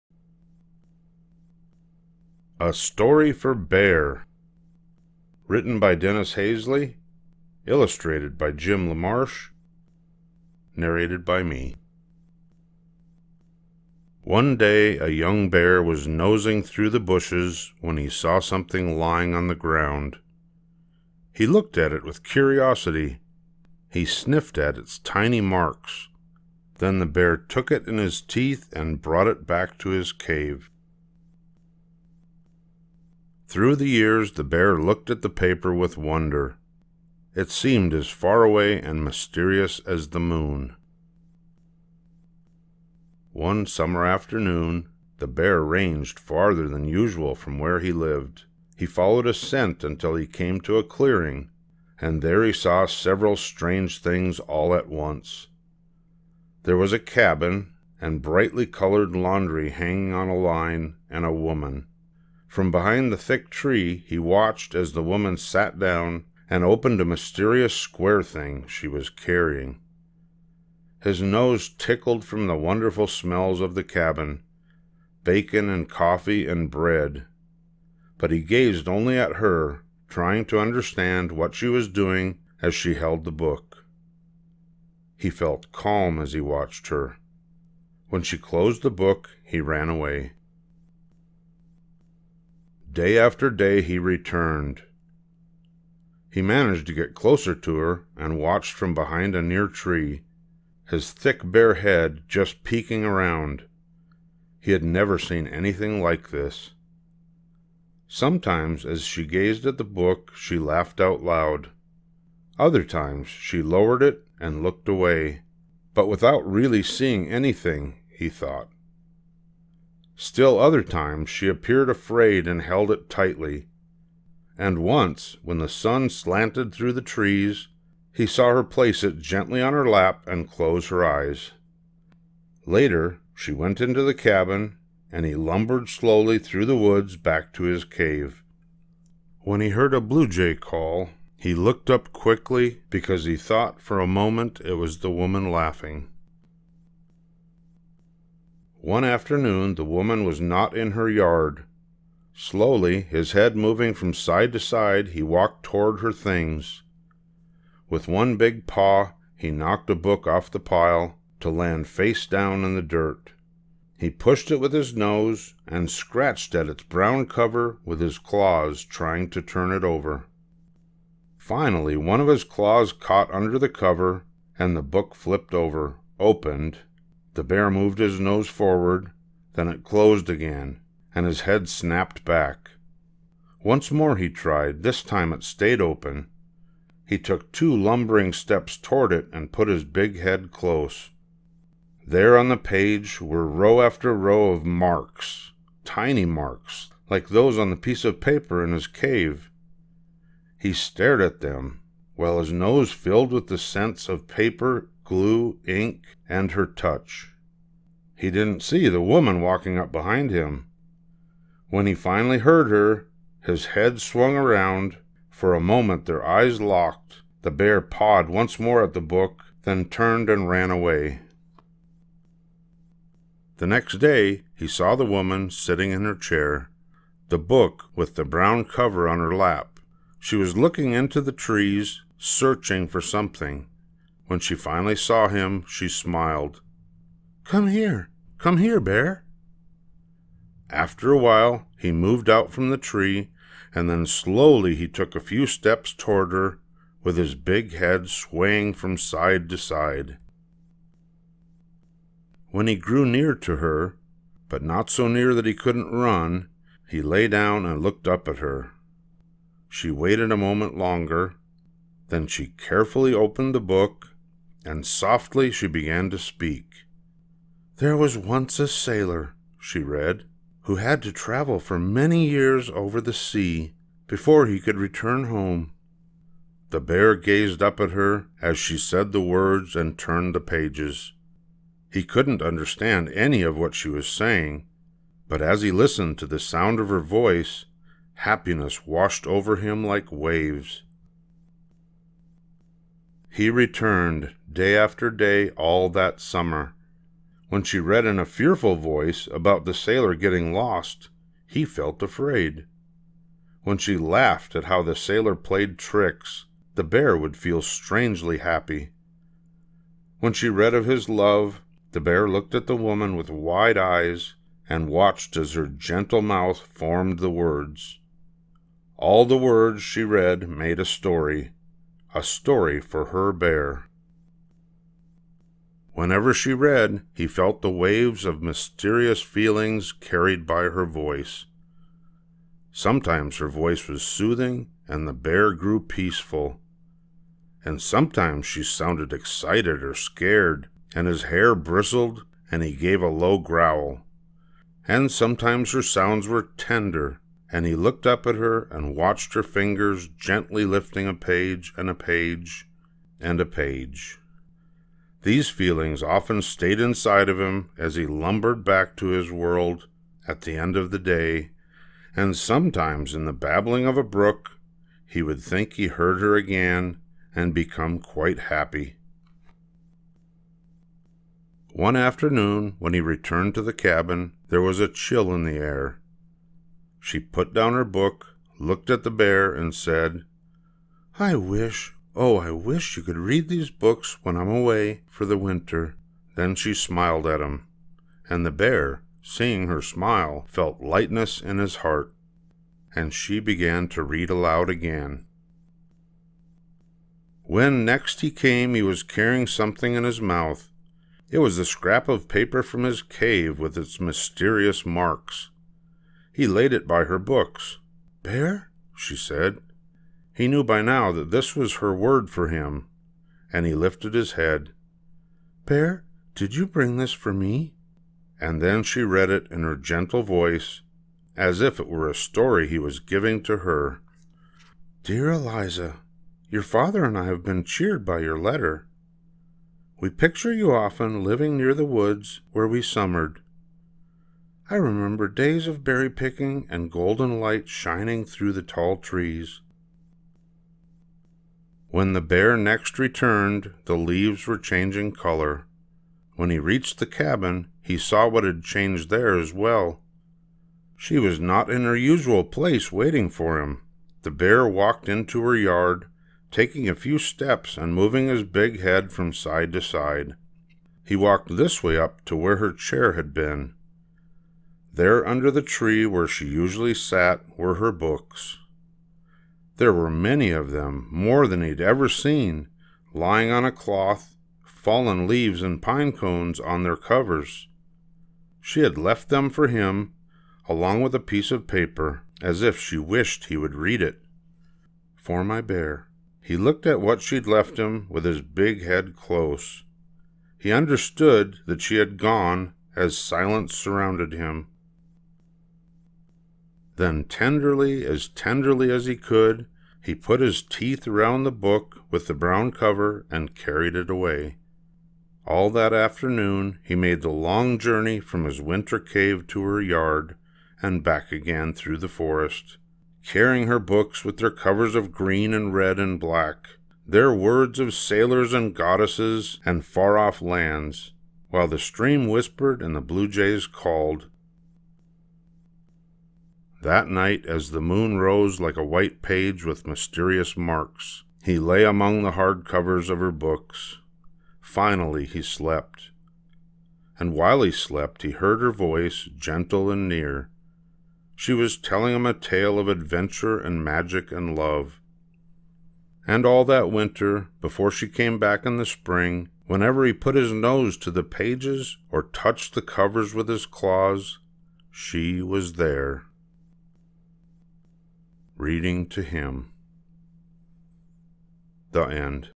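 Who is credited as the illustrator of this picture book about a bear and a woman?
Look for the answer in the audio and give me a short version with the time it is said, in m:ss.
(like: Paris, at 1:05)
Jim LaMarche, at 0:08.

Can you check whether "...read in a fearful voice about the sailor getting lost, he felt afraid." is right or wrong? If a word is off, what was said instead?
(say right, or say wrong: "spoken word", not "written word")
right.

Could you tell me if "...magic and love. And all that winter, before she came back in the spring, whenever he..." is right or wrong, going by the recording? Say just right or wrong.
right.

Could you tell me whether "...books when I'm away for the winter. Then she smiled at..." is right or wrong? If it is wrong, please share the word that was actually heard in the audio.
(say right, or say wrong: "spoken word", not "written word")
right.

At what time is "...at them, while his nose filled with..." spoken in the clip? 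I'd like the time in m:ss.
3:21.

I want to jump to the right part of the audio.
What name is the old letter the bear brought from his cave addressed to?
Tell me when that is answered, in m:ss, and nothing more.
7:05.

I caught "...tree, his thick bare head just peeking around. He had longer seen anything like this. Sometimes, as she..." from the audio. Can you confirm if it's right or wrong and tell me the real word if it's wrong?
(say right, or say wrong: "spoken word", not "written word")
wrong: "never", not "longer".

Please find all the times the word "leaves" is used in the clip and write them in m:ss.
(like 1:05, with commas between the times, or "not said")
7:23, 7:55.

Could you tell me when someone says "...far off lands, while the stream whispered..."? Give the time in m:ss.
8:39.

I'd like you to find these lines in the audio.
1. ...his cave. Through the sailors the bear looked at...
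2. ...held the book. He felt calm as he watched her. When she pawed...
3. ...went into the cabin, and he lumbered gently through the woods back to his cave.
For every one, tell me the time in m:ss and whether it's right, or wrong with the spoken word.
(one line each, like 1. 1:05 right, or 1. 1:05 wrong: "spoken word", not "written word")
1. 0:29 wrong: "years", not "sailors"
2. 1:22 wrong: "closed", not "pawed"
3. 2:13 wrong: "slowly", not "gently".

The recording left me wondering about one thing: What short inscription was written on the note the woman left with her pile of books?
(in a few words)
For my bear.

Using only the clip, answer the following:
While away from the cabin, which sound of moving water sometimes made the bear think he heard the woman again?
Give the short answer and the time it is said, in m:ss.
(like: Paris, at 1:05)
babbling of a brook, at 6:03.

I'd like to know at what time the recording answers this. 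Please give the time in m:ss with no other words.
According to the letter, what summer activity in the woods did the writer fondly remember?
7:15.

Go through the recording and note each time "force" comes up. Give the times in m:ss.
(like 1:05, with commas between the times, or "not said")
not said.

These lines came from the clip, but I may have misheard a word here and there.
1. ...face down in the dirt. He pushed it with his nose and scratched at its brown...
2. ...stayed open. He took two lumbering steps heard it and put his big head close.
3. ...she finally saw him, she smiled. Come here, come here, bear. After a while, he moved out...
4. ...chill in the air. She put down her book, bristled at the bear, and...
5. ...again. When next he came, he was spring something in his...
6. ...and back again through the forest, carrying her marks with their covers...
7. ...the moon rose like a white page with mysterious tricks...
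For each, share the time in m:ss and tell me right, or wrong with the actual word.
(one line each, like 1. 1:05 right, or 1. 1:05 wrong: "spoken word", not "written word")
1. 2:41 right
2. 3:05 wrong: "toward", not "heard"
3. 3:54 right
4. 6:14 wrong: "looked", not "bristled"
5. 6:34 wrong: "carrying", not "spring"
6. 8:30 wrong: "books", not "marks"
7. 8:47 wrong: "marks", not "tricks".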